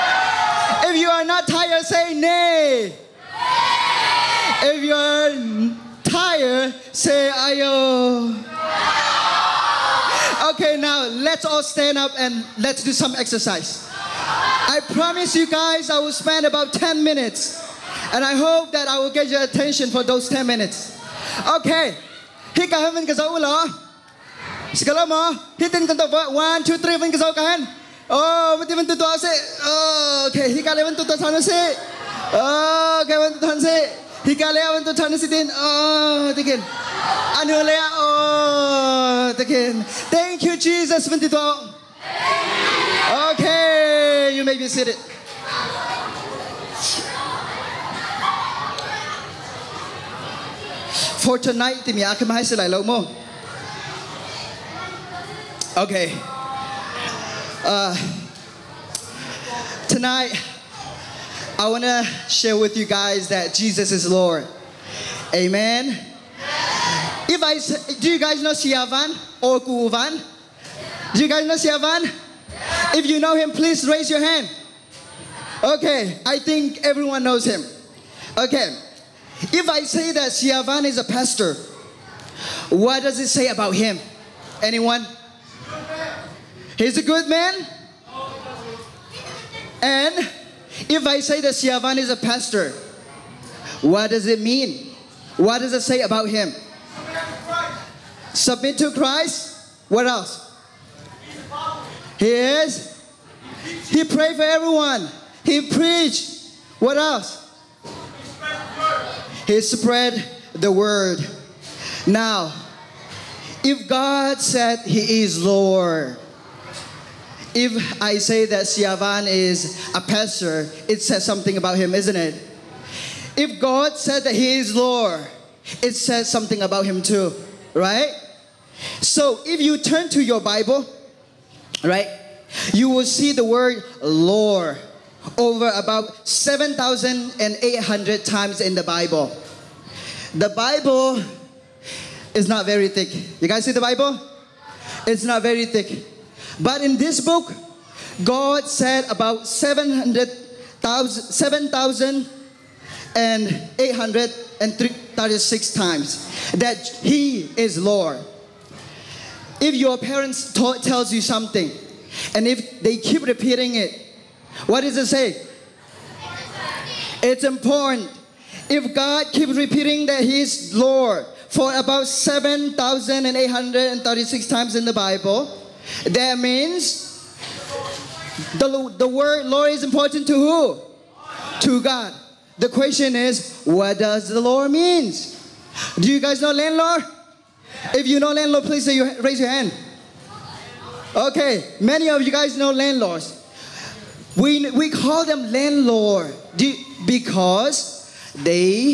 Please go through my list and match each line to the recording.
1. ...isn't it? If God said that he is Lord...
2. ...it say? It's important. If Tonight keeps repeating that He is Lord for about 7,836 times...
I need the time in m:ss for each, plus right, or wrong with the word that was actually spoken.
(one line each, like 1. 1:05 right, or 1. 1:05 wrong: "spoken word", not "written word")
1. 2:01 right
2. 2:44 wrong: "God", not "Tonight".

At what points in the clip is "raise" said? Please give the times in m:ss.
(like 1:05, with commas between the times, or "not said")
1:13, 3:09.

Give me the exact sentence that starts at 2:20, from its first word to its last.
The Bible is not very thick.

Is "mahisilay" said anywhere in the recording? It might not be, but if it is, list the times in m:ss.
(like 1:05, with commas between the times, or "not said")
0:52.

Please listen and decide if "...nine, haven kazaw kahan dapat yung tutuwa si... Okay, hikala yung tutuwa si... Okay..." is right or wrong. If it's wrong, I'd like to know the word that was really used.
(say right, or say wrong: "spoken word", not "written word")
wrong: "three", not "nine".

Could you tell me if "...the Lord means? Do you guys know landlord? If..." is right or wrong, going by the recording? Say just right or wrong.
right.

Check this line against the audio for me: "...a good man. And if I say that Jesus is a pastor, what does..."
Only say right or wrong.
wrong.